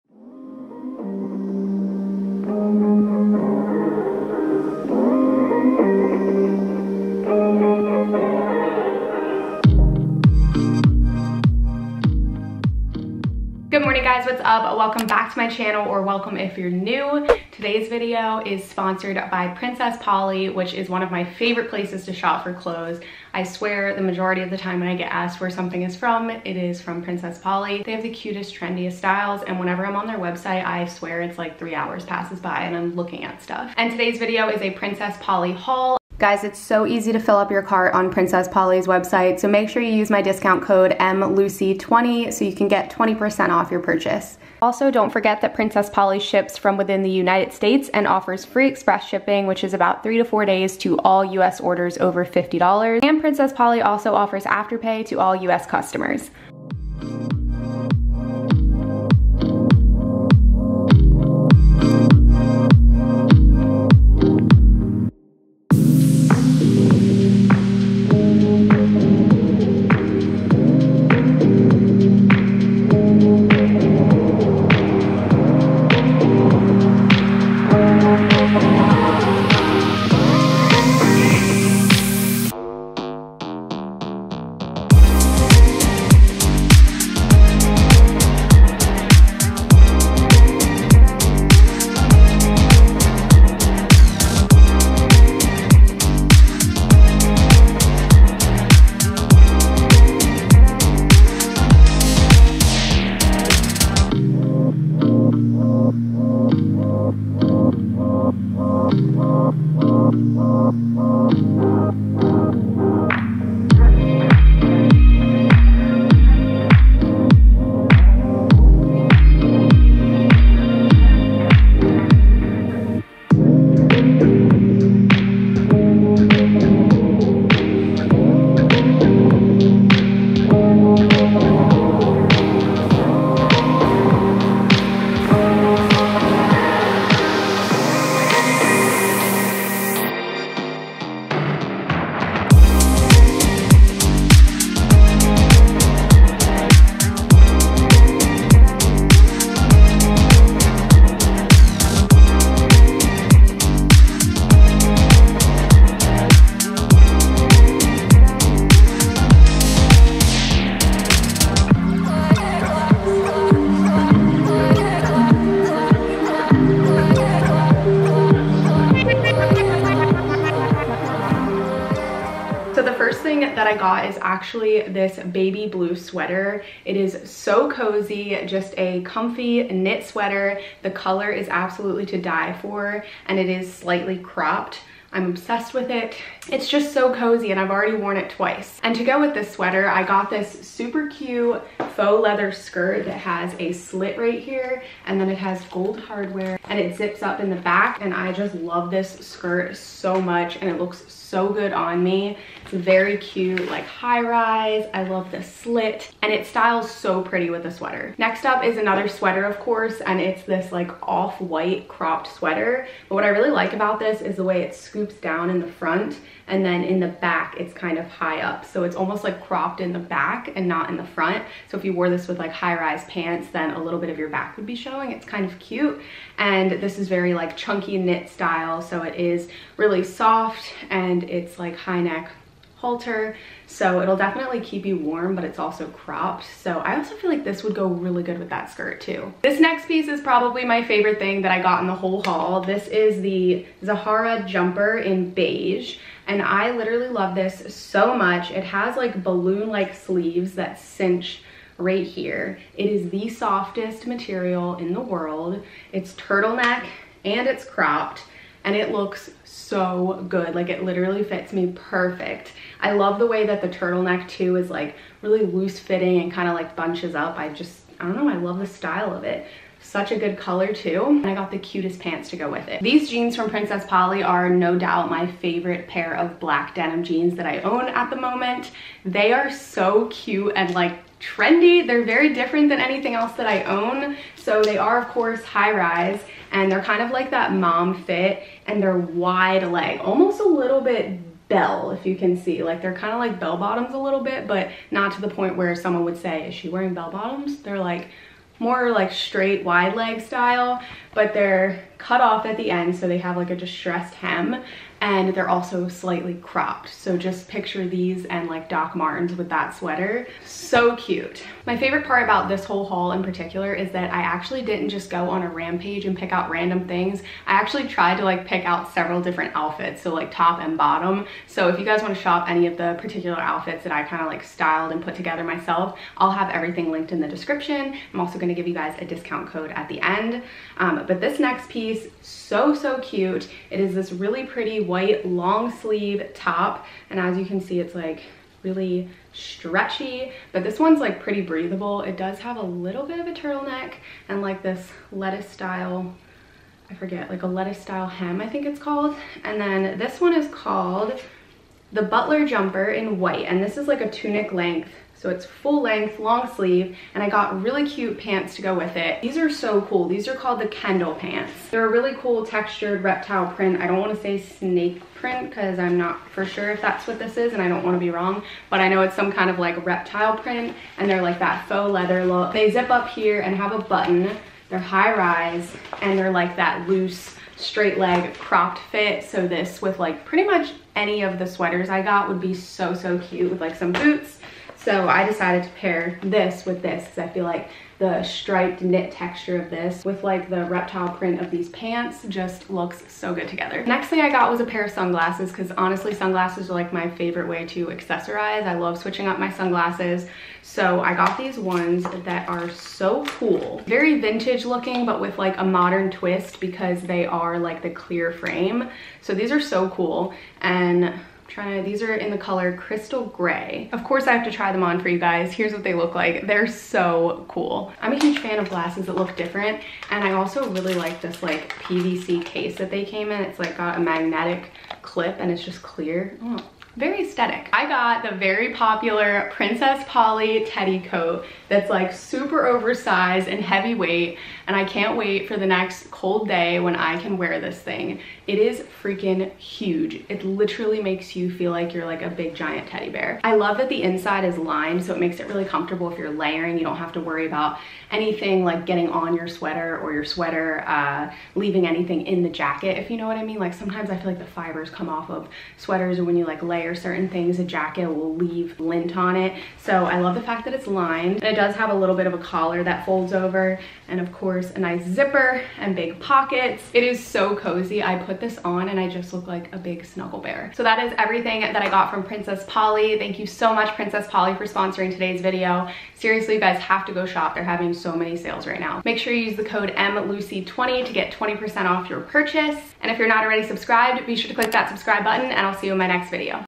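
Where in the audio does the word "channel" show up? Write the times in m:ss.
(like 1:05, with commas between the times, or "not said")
0:15.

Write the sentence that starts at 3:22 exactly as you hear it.
It's very cute, like high rise.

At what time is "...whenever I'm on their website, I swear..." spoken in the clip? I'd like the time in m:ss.
0:29.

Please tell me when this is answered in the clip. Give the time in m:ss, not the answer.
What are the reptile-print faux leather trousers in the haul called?
6:00.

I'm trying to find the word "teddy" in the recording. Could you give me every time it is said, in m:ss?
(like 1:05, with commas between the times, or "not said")
7:10, 7:22.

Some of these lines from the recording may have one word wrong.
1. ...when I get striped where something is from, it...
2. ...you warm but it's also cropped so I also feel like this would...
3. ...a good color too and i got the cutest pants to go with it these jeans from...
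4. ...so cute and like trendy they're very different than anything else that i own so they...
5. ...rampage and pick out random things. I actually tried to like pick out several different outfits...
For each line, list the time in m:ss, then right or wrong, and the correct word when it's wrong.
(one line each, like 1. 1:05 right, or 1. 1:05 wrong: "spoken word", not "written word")
1. 0:24 wrong: "asked", not "striped"
2. 3:54 right
3. 4:30 right
4. 4:39 right
5. 5:15 right.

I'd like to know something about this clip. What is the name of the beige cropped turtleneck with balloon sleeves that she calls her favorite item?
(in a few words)
Zahara jumper.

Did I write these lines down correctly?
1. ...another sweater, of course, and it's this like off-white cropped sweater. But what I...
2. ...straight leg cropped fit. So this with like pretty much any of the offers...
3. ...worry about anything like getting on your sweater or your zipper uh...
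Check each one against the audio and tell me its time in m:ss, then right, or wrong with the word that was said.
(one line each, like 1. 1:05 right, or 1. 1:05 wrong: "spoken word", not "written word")
1. 3:28 right
2. 6:17 wrong: "sweaters", not "offers"
3. 7:27 wrong: "sweater", not "zipper".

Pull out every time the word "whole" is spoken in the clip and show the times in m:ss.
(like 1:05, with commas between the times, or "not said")
4:01, 5:12.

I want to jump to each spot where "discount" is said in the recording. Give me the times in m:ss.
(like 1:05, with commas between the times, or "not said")
0:40, 5:29.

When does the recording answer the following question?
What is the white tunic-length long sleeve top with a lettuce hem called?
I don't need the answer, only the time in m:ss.
5:52.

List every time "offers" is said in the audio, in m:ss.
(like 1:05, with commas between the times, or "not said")
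0:48, 0:54.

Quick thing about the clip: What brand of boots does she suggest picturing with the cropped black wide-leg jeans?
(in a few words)
Doc Martens.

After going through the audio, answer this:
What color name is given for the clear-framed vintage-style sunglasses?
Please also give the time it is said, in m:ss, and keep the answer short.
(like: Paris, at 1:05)
Crystal Gray, at 6:52.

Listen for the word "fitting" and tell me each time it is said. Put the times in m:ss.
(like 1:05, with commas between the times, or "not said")
4:25.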